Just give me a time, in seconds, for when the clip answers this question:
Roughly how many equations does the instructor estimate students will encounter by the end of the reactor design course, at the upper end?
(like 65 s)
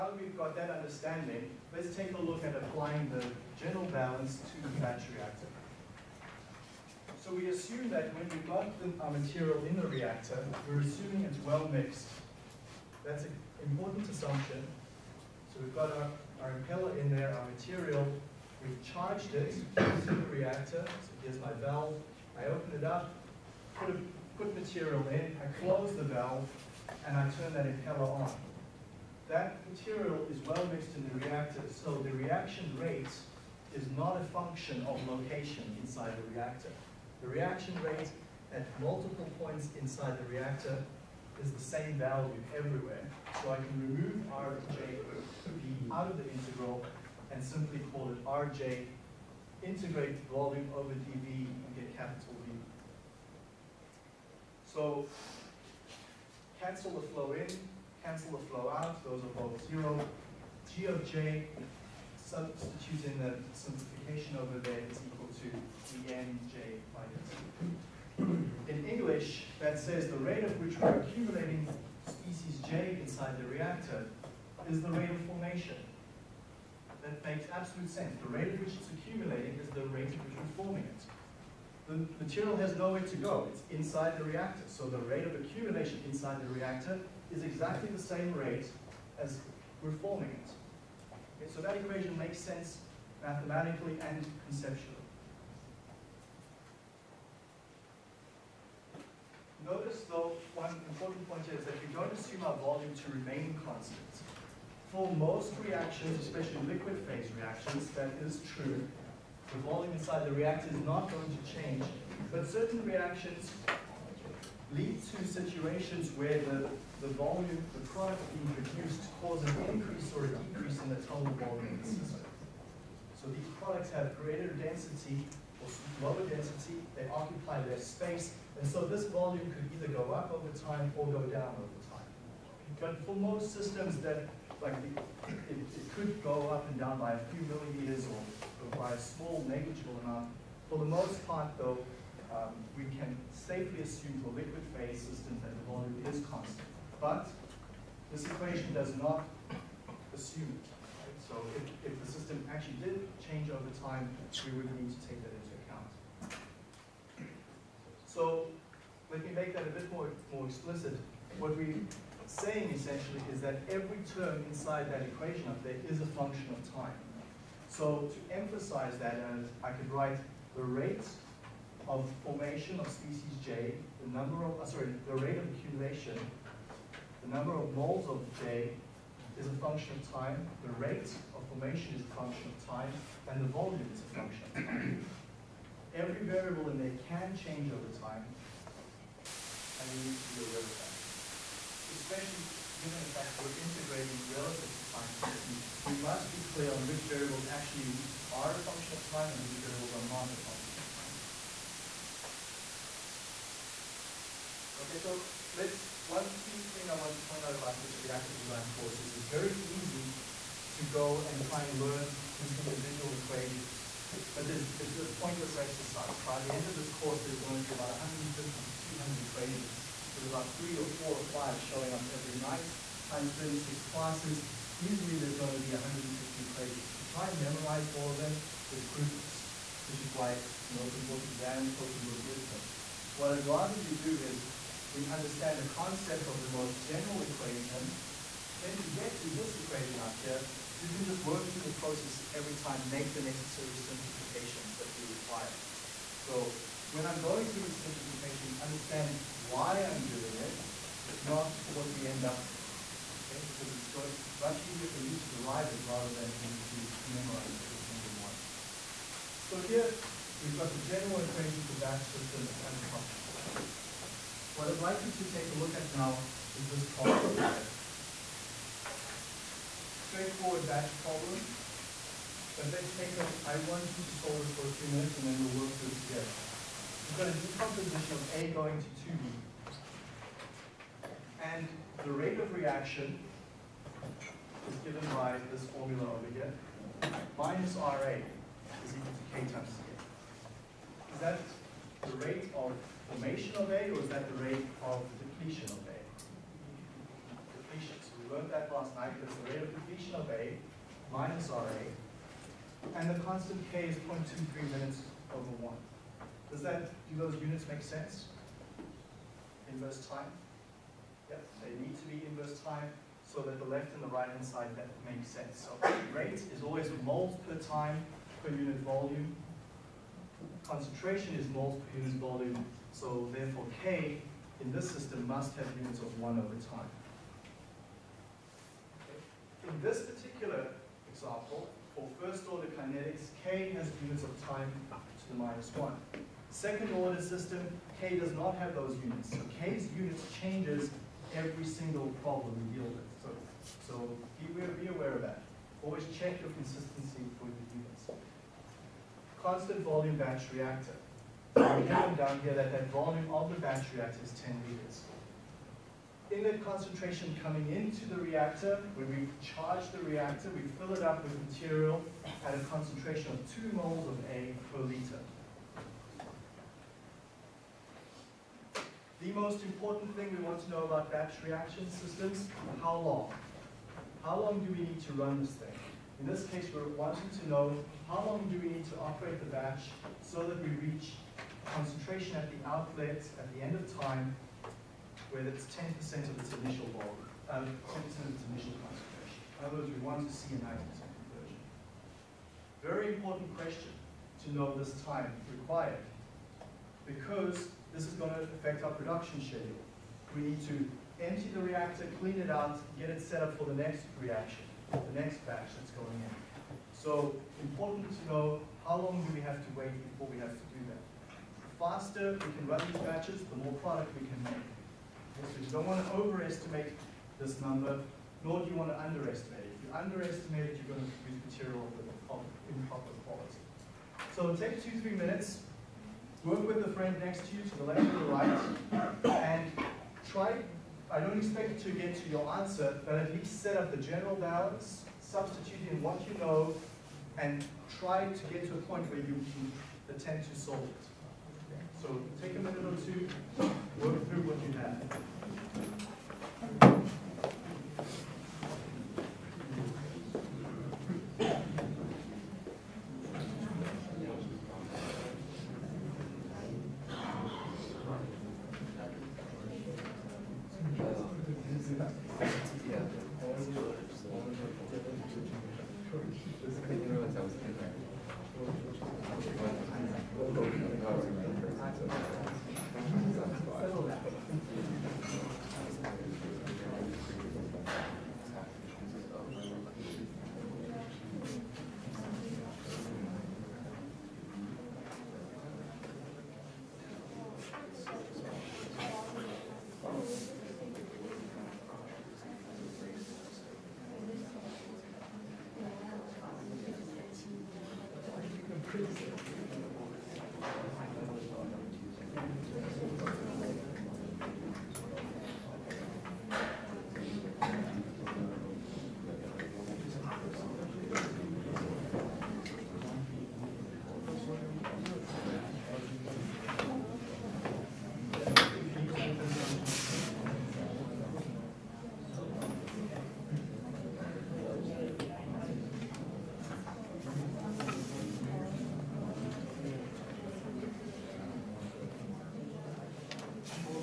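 217 s.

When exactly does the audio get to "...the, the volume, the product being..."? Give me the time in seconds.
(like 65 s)
116 s.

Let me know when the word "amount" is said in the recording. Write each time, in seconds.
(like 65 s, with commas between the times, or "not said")
140 s.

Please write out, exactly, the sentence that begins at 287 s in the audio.
Minus RA is equal to K times K.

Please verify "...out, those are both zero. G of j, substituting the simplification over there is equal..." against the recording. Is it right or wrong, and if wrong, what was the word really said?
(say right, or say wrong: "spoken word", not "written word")
right.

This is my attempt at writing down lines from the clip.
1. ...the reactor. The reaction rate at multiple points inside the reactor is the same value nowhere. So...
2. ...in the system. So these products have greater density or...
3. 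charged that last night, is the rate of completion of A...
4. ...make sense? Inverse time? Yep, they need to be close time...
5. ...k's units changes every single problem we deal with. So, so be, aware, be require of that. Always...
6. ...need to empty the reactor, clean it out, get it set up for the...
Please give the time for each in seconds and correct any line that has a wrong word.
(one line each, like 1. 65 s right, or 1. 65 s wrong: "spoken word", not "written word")
1. 36 s wrong: "everywhere", not "nowhere"
2. 121 s right
3. 298 s wrong: "learned", not "charged"
4. 307 s wrong: "inverse", not "close"
5. 339 s wrong: "aware", not "require"
6. 400 s right.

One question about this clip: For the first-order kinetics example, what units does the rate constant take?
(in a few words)
time to the minus 1.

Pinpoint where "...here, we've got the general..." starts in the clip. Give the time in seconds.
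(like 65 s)
259 s.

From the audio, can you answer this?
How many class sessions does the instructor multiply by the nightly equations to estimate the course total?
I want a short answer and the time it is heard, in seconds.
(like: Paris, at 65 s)
36, at 223 s.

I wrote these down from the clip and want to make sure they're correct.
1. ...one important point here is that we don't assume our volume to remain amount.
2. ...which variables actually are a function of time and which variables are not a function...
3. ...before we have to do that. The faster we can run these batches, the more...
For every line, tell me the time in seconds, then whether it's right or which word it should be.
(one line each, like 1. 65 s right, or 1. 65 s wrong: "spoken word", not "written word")
1. 100 s wrong: "constant", not "amount"
2. 196 s right
3. 410 s right.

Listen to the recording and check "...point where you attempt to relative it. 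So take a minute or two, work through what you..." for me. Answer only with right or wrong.
wrong.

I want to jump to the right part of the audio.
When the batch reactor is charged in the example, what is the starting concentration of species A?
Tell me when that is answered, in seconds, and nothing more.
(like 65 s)
363 s.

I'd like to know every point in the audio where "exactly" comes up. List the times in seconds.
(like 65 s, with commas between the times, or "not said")
87 s.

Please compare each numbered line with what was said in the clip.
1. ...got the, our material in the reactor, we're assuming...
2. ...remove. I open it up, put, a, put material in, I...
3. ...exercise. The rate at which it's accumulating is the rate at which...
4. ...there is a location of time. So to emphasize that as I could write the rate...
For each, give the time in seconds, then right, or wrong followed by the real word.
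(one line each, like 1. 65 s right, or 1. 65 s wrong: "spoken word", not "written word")
1. 8 s right
2. 21 s wrong: "valve", not "remove"
3. 77 s wrong: "sense", not "exercise"
4. 165 s wrong: "function", not "location".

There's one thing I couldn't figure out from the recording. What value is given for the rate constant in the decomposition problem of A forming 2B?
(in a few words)
0.23 per minute.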